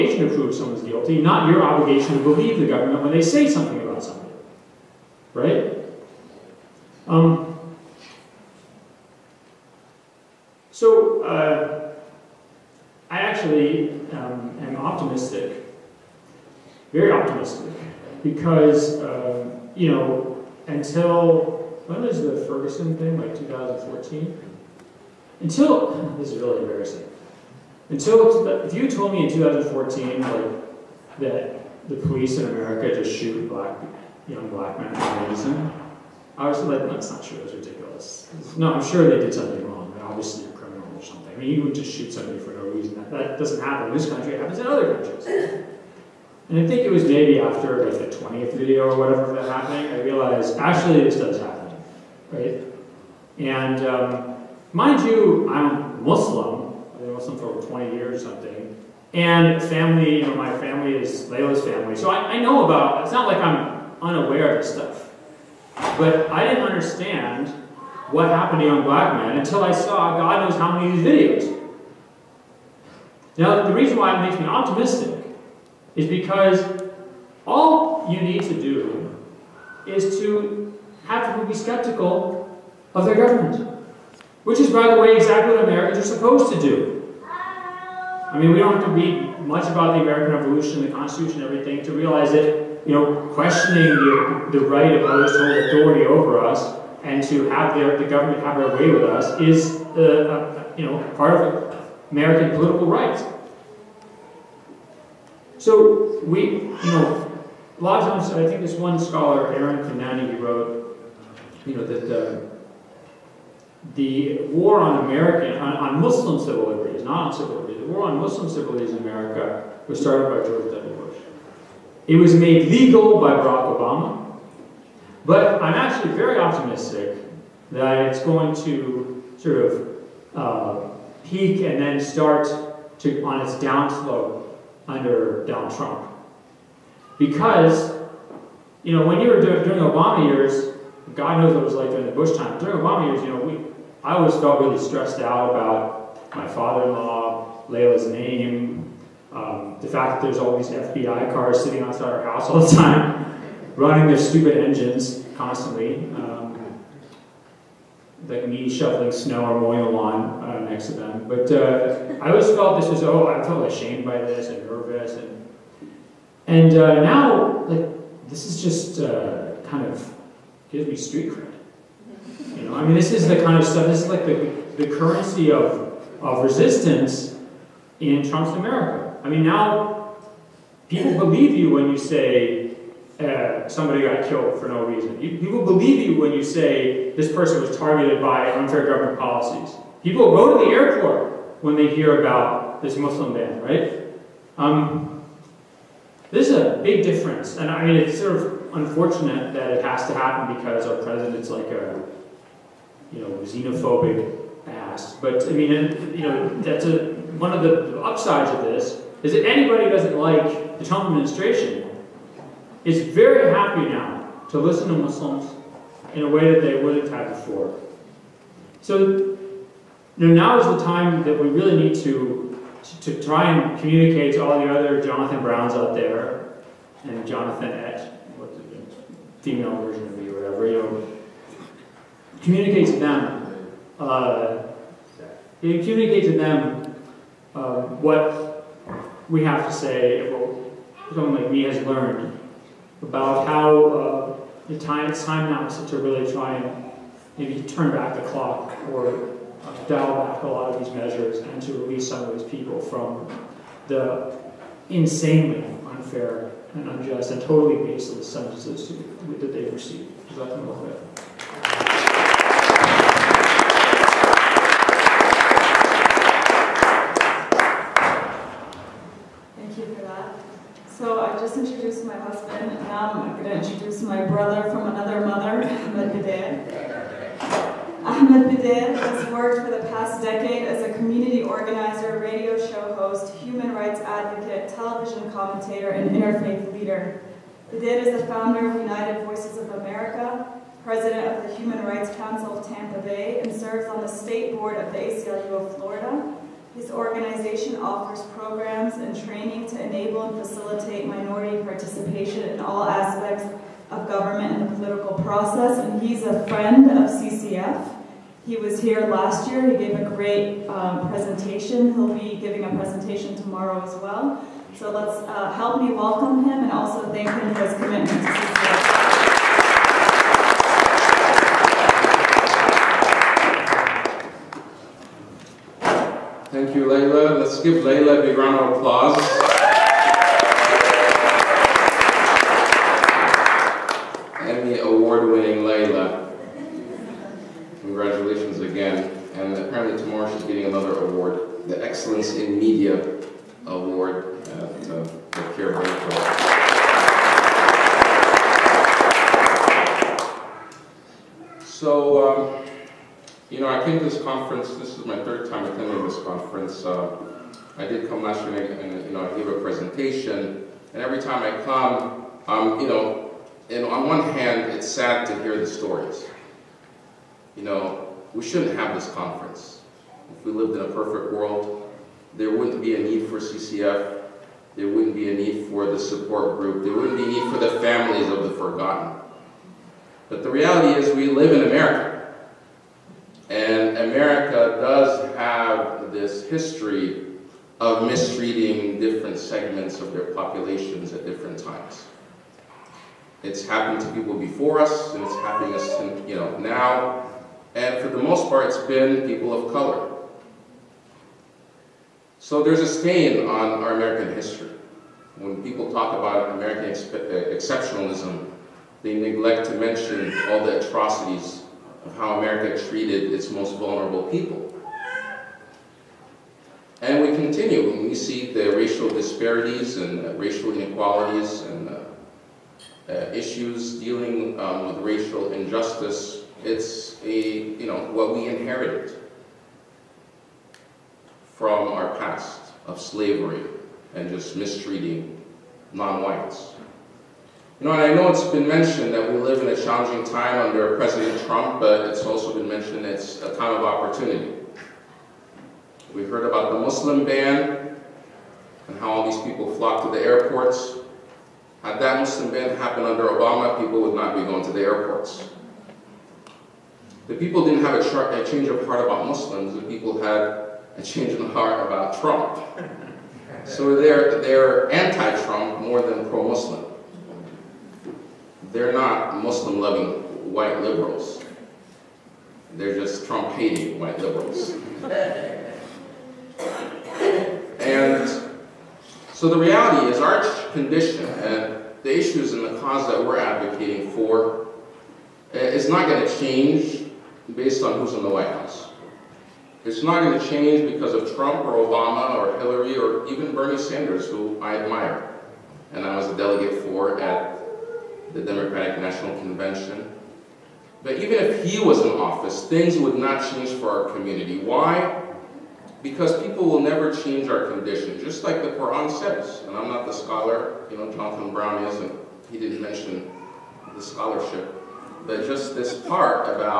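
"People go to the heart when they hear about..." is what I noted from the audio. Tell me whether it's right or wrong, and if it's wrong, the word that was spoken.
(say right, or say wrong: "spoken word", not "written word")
wrong: "airport", not "heart".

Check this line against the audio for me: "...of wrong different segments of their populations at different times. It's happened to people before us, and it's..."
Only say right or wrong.
wrong.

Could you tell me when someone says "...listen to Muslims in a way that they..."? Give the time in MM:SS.
03:34.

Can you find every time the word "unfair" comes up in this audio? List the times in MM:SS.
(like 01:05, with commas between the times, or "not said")
03:08, 04:15.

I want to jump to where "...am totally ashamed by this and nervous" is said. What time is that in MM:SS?
02:43.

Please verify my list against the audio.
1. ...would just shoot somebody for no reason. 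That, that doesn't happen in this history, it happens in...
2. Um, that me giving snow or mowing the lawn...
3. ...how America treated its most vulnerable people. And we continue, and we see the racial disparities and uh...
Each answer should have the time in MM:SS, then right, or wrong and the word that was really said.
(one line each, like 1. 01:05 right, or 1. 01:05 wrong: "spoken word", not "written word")
1. 00:41 wrong: "country", not "history"
2. 02:36 wrong: "shoveling", not "giving"
3. 06:52 right.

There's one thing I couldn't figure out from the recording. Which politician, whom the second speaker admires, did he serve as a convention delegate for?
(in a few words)
Bernie Sanders.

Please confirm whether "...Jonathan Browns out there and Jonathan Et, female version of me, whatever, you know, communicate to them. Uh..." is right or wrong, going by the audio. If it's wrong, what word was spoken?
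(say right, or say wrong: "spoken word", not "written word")
right.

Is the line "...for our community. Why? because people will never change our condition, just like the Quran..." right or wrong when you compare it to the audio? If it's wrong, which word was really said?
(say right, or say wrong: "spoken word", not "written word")
right.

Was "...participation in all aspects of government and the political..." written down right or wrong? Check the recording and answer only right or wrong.
right.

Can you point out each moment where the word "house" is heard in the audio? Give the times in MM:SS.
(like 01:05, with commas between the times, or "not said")
02:32, 08:08.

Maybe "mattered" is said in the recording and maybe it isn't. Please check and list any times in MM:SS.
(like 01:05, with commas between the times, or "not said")
not said.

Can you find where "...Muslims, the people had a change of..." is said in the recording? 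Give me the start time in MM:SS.
07:39.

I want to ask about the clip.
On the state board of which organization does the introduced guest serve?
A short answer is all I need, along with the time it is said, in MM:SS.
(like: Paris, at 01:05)
ACLU of Florida, at 04:54.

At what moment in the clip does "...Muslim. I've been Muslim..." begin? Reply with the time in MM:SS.
00:56.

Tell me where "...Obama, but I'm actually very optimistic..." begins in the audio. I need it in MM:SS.
02:03.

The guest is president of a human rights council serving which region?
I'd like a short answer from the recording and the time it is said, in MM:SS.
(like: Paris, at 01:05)
Tampa Bay, at 04:52.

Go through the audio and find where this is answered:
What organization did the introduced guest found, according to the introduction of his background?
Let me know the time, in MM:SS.
04:48.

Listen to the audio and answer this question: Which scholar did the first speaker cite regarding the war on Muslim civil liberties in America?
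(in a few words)
Arun Kundnani.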